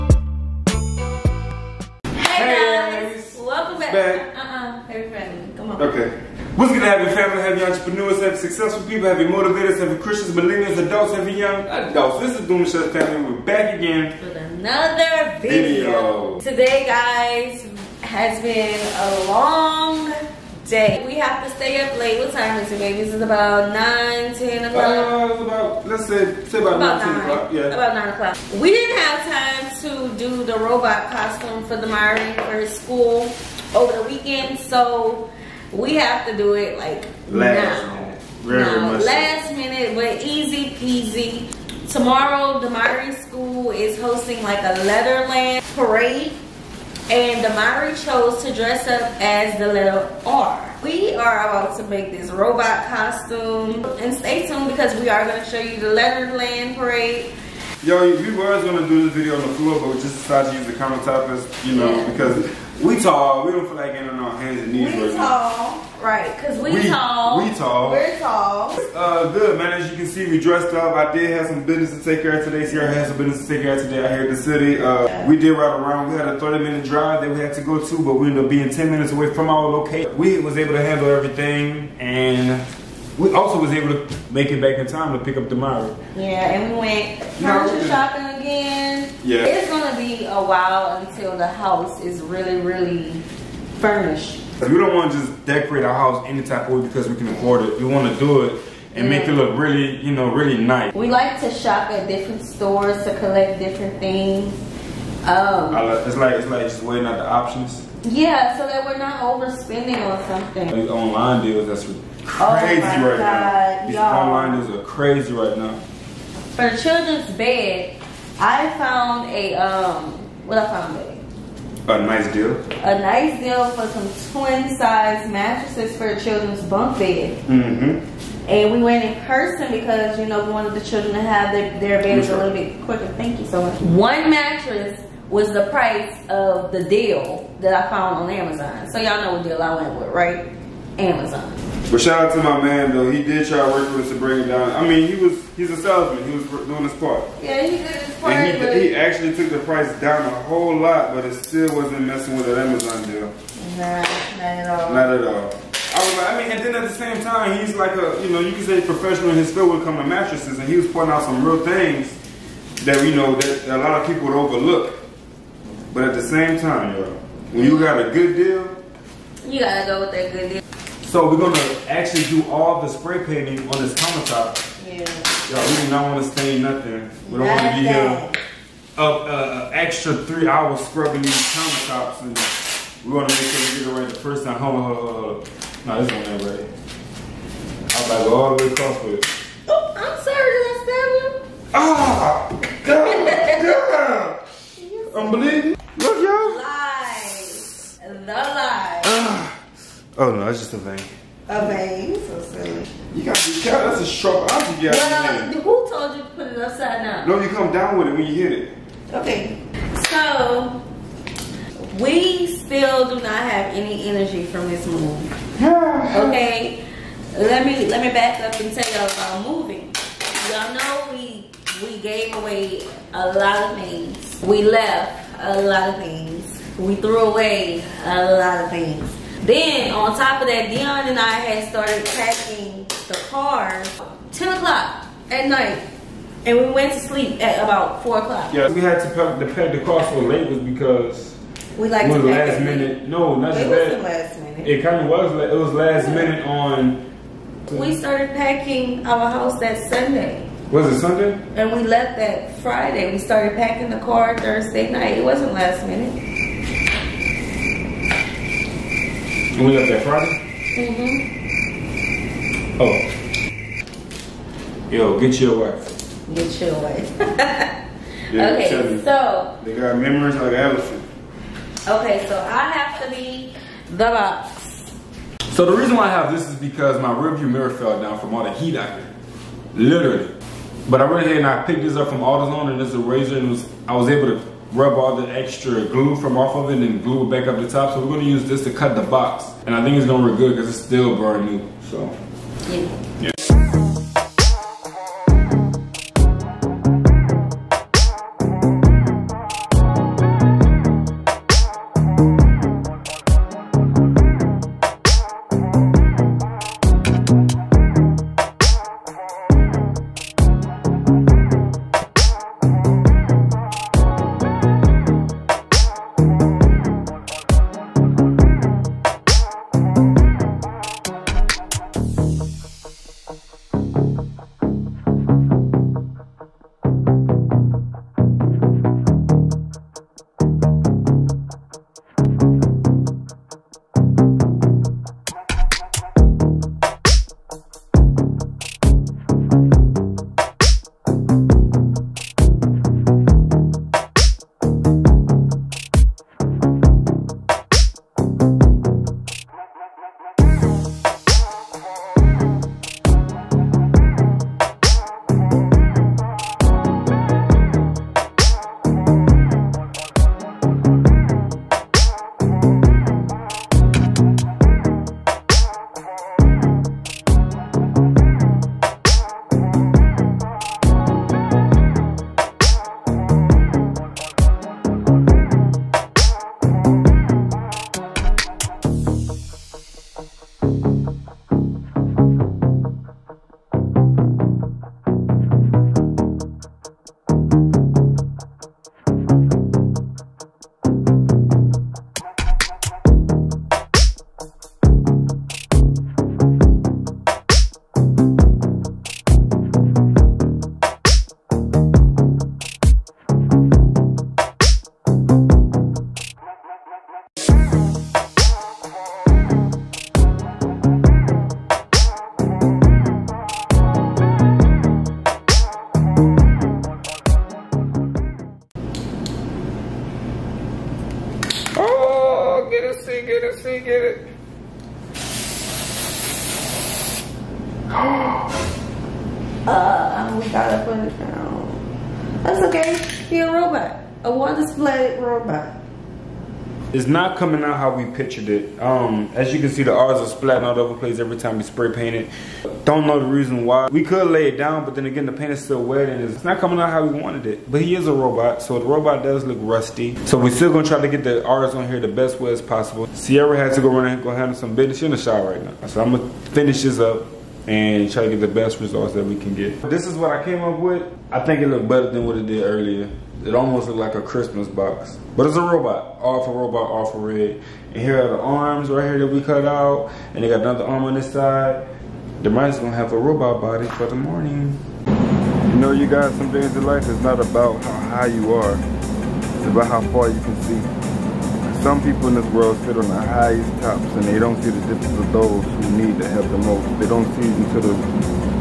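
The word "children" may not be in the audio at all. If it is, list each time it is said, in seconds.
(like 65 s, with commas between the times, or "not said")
116 s, 126 s, 130 s.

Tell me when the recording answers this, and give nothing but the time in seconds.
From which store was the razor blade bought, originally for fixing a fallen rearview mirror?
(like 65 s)
282 s.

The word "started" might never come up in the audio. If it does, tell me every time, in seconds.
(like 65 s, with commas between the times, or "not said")
231 s, 247 s, 253 s.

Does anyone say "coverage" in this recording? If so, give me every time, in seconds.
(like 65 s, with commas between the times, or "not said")
not said.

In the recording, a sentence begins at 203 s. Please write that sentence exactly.
That's a sharp object you got well, Who told you to put it upside down?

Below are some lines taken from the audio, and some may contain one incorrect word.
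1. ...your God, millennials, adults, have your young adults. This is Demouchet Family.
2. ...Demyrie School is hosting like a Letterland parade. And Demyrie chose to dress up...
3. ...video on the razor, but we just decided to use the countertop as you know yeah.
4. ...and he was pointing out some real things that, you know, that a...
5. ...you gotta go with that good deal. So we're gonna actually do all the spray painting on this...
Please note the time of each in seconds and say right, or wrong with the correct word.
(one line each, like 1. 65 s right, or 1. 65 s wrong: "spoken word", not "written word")
1. 9 s wrong: "Christians", not "God"
2. 42 s right
3. 59 s wrong: "floor", not "razor"
4. 160 s right
5. 169 s right.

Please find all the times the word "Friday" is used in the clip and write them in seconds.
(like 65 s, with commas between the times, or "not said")
252 s, 260 s.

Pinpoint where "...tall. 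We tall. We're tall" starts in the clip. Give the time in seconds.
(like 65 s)
66 s.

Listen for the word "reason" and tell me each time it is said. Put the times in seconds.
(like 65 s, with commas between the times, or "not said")
275 s, 443 s.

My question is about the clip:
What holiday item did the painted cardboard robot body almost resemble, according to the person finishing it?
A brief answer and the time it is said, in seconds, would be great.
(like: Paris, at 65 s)
Christmas box, at 464 s.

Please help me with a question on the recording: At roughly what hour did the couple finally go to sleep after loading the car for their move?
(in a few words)
4 o'clock.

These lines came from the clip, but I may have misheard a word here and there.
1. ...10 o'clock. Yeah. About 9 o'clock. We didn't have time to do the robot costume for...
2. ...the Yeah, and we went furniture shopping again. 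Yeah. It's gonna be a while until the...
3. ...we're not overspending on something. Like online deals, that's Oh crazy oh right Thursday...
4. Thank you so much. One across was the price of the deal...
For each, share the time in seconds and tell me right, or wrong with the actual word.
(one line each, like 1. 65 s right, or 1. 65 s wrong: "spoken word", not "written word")
1. 27 s right
2. 85 s right
3. 108 s wrong: "God", not "Thursday"
4. 133 s wrong: "mattress", not "across".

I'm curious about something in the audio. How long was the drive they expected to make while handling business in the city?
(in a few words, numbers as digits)
30 minutes.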